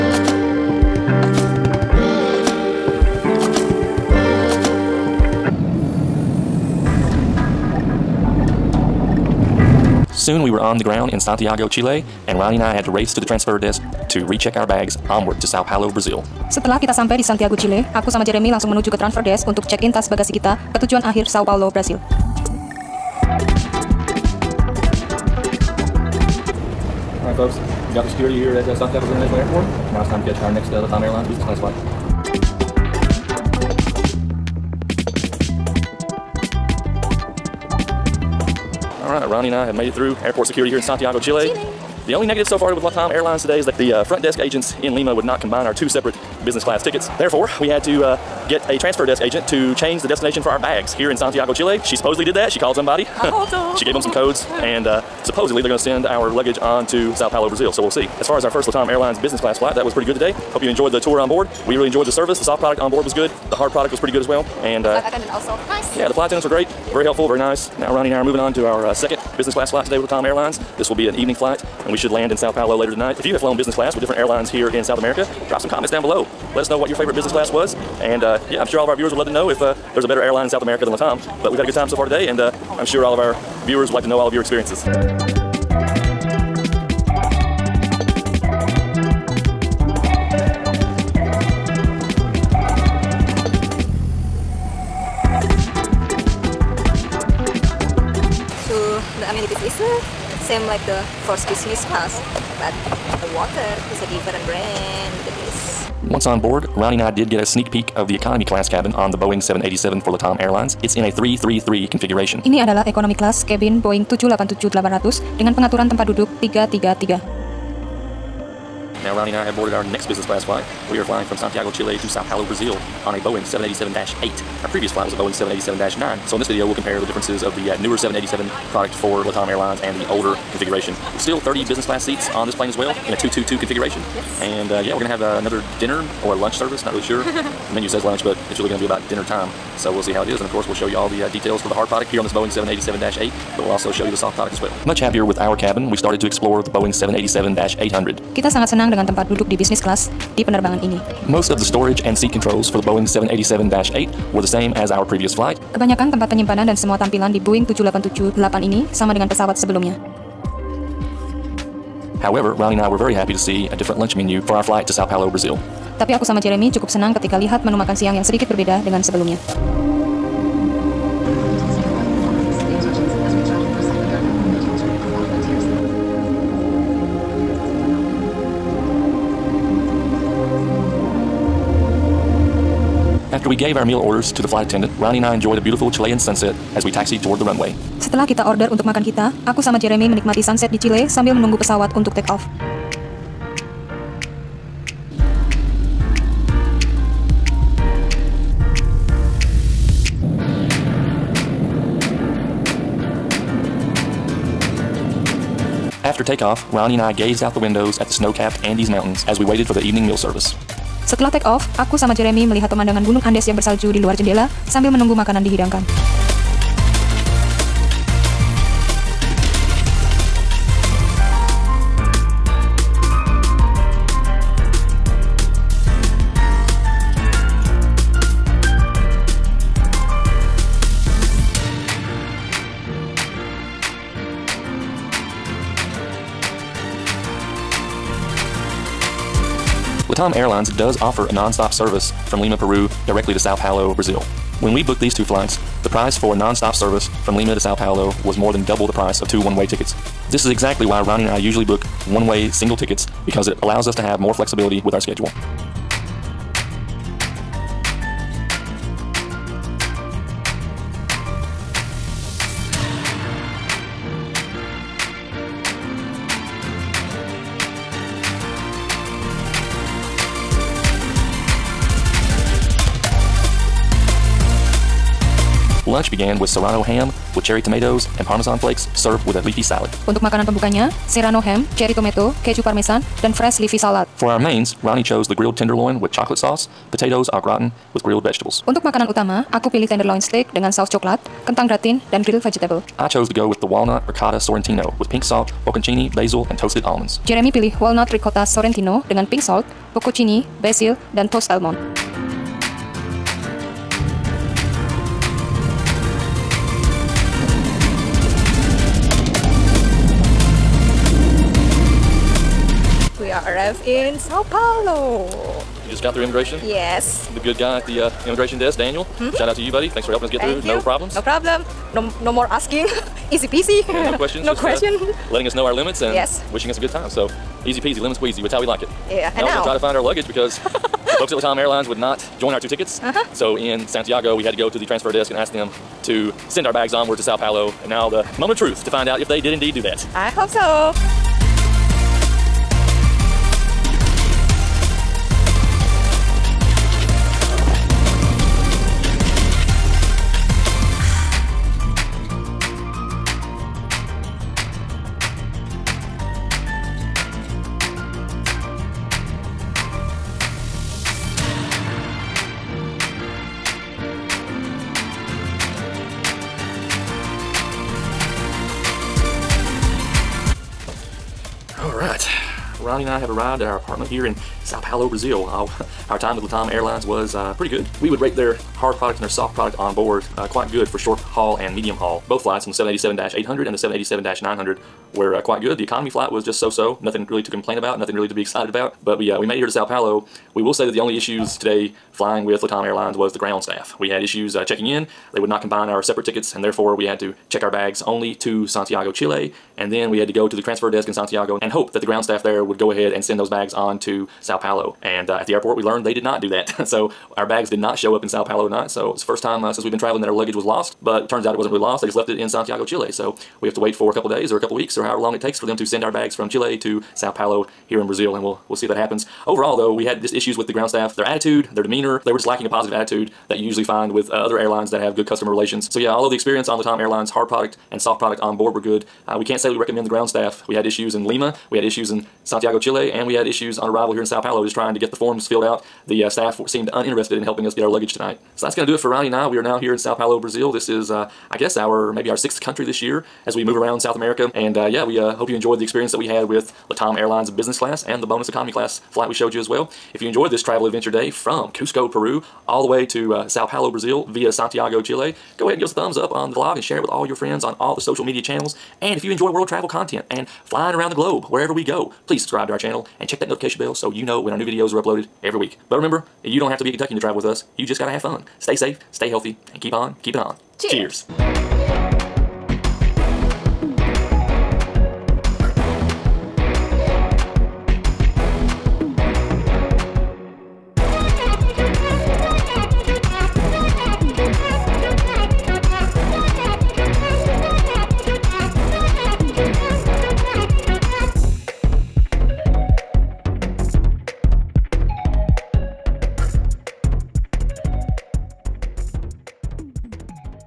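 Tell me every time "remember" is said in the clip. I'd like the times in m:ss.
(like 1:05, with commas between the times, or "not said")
7:45.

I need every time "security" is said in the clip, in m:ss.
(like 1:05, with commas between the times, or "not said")
0:28, 0:40.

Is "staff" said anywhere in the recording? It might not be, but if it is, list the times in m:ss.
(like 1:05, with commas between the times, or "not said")
6:33, 6:42, 7:00, 7:10, 7:16.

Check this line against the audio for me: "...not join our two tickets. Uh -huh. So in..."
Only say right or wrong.
right.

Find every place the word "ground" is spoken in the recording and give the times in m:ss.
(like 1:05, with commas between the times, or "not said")
0:10, 6:33, 6:42, 7:00, 7:10.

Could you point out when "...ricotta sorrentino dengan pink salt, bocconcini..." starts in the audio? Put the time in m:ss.
4:58.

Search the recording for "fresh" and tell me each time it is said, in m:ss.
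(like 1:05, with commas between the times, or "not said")
4:43.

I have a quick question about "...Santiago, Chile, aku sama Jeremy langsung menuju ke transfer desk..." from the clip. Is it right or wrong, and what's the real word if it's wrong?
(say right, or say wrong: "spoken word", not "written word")
right.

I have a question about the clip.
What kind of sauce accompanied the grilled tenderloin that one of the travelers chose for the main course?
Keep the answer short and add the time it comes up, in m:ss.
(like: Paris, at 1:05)
chocolate sauce, at 4:46.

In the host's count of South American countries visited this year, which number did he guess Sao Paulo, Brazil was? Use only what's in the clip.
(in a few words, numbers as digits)
sixth.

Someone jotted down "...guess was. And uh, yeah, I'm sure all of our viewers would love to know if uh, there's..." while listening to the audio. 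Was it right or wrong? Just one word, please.
wrong.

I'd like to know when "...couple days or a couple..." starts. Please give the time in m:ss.
6:54.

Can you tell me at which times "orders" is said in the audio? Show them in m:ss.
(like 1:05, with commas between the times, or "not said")
3:04, 3:08.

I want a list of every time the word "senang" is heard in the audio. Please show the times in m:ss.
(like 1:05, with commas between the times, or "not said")
2:28, 2:46.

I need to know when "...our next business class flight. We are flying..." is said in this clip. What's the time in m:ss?
1:59.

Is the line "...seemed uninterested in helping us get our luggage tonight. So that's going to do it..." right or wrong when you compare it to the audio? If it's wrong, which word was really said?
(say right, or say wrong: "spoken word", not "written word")
right.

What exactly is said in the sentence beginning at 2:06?
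So in this video, we'll compare the differences of the uh, newer 787 product for LATAM Airlines and the older configuration.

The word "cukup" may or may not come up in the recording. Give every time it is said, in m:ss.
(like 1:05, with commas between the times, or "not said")
2:46.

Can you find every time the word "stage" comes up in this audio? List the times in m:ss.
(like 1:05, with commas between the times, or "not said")
not said.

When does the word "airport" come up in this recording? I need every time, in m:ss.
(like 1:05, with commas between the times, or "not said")
0:29, 0:40, 6:45.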